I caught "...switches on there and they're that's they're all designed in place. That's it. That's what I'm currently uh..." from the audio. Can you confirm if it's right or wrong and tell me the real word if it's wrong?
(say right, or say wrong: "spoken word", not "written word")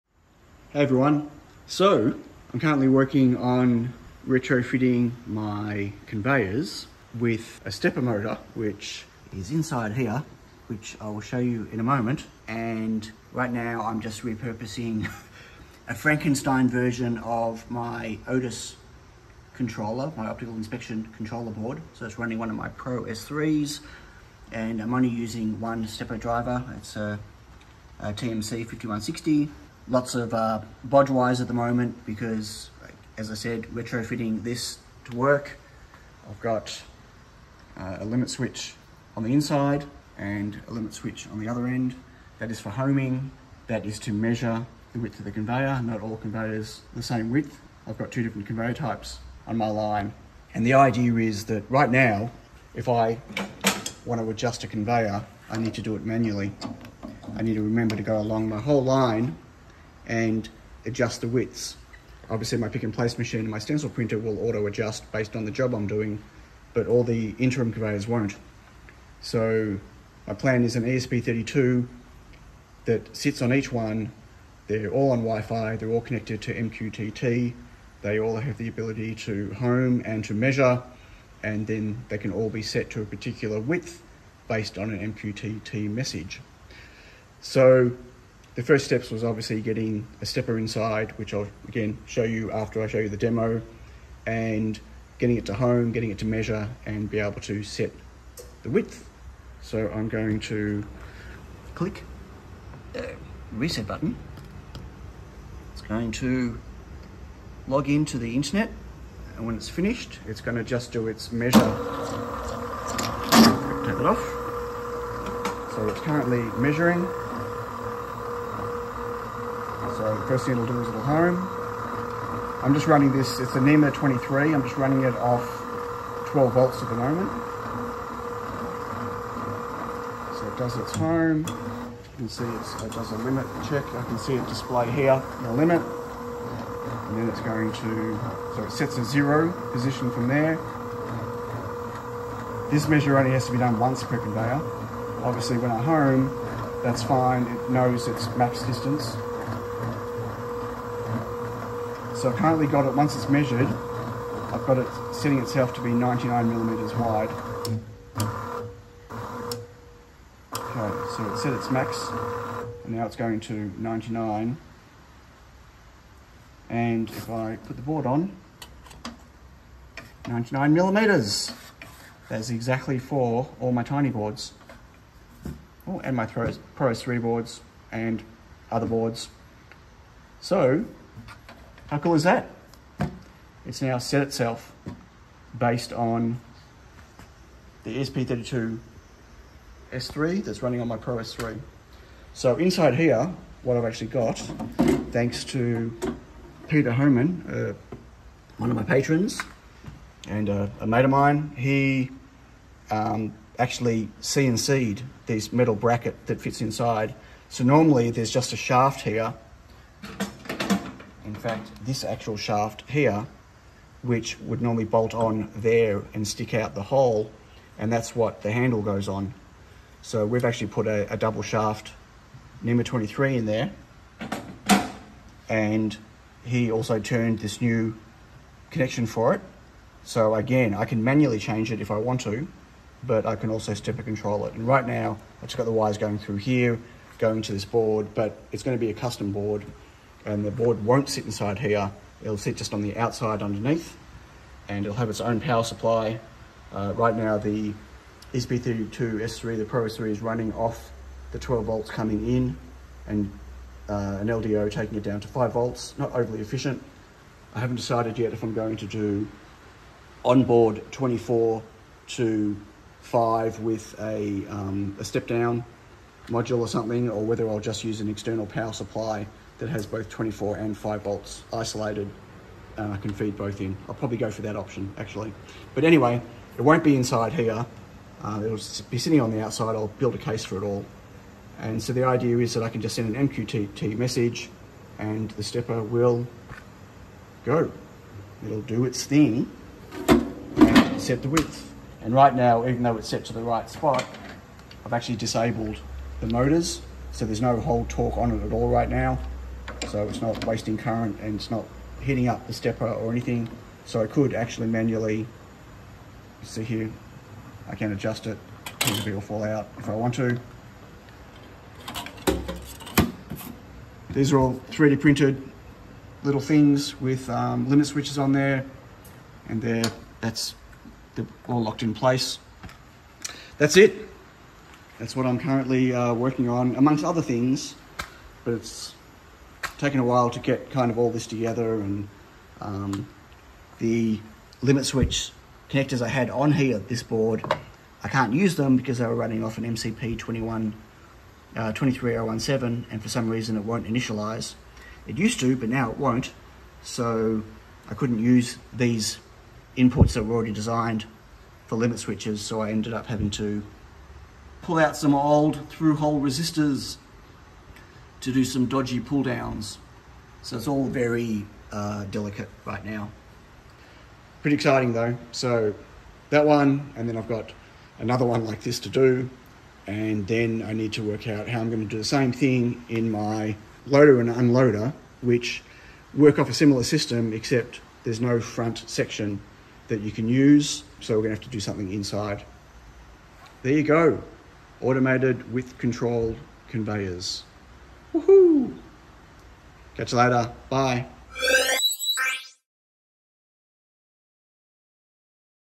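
wrong: "locked", not "designed".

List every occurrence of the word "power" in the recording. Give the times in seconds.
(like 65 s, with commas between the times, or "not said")
245 s, 268 s.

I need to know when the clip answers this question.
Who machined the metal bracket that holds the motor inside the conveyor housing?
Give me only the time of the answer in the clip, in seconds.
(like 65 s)
196 s.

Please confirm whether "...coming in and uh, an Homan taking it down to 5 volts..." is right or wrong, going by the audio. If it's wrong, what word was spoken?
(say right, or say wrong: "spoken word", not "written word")
wrong: "LDO", not "Homan".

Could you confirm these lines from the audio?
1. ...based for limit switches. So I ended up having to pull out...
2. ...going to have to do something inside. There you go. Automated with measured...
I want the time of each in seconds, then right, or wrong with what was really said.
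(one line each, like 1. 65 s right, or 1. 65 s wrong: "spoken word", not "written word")
1. 350 s wrong: "designed", not "based"
2. 381 s wrong: "controlled", not "measured".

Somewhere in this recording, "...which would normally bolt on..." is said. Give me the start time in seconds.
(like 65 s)
214 s.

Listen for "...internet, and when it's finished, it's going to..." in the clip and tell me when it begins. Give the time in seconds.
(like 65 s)
108 s.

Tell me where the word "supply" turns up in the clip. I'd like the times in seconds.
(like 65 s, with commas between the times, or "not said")
245 s, 268 s.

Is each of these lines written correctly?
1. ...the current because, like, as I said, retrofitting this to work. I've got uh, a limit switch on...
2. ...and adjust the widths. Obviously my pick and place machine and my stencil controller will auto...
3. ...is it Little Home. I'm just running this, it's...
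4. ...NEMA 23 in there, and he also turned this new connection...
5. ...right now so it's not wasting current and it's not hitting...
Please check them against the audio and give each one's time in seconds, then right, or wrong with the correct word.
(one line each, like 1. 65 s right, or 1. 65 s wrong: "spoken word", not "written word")
1. 31 s wrong: "moment", not "current"
2. 60 s wrong: "printer", not "controller"
3. 120 s right
4. 222 s right
5. 298 s right.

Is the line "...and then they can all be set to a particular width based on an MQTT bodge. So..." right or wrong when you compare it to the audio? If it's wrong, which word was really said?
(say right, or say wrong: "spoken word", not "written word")
wrong: "message", not "bodge".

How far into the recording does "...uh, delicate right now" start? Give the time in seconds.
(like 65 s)
361 s.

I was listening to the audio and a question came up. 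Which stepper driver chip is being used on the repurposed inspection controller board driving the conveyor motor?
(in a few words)
TMC 5160.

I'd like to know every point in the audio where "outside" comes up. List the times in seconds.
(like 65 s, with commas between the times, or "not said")
242 s, 279 s.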